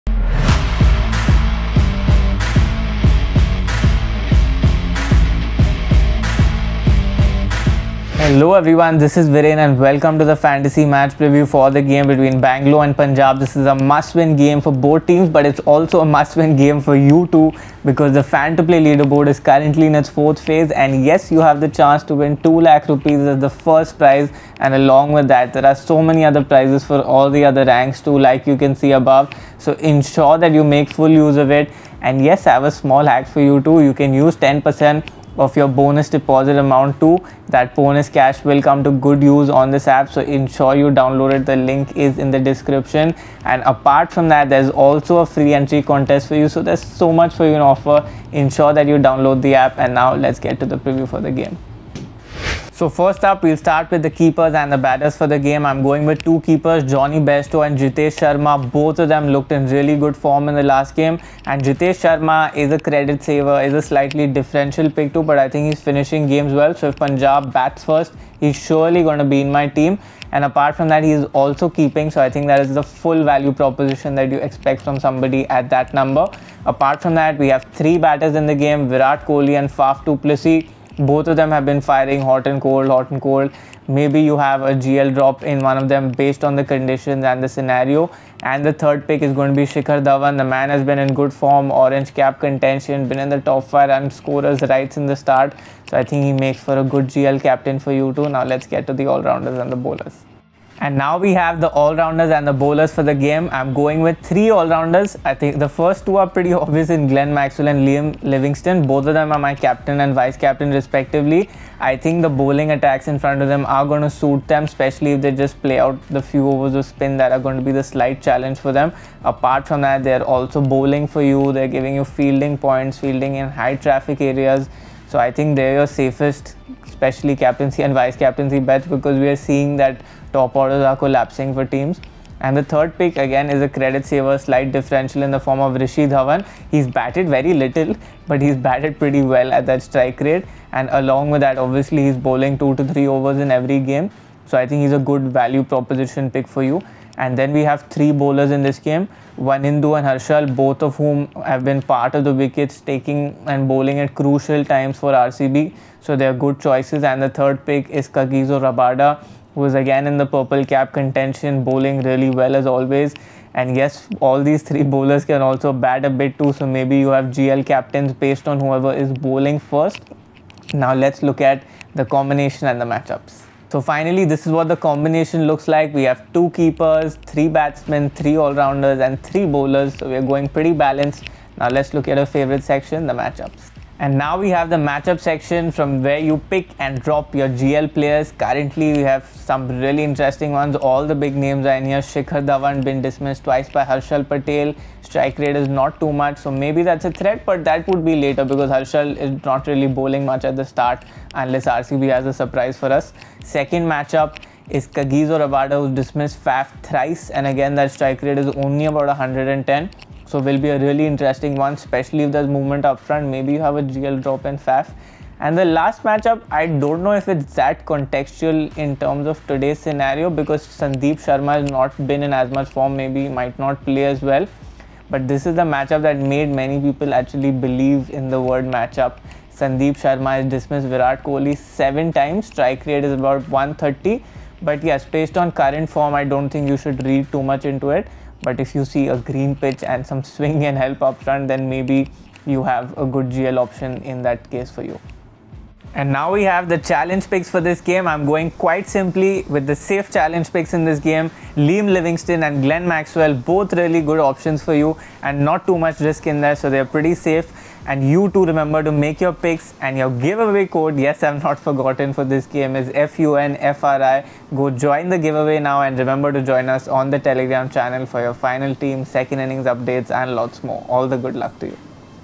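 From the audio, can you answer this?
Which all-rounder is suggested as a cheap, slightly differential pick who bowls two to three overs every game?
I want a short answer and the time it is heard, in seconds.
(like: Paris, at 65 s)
Rishi Dhawan, at 135 s.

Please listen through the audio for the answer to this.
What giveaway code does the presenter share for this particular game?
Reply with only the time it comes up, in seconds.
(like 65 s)
263 s.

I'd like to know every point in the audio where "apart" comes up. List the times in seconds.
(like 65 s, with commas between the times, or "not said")
43 s, 70 s, 76 s, 119 s.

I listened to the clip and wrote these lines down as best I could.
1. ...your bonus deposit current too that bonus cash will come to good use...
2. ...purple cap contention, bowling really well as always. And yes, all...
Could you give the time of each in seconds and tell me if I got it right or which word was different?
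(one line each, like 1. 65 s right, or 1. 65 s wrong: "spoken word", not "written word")
1. 35 s wrong: "amount", not "current"
2. 160 s right.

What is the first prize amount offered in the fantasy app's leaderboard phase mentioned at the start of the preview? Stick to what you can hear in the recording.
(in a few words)
2 lakh rupees.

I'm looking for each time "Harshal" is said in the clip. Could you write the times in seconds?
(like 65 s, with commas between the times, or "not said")
150 s, 193 s, 198 s.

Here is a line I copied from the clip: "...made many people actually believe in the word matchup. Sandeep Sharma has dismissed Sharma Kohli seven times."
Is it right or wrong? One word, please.
wrong.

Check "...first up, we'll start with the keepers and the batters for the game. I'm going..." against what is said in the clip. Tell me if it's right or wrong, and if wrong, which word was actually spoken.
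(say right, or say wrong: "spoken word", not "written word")
right.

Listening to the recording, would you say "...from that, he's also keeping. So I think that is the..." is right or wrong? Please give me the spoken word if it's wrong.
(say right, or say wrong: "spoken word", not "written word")
right.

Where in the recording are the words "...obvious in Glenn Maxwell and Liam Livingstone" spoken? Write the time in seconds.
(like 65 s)
106 s.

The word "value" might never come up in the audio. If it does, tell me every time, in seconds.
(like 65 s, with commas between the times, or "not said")
73 s, 145 s.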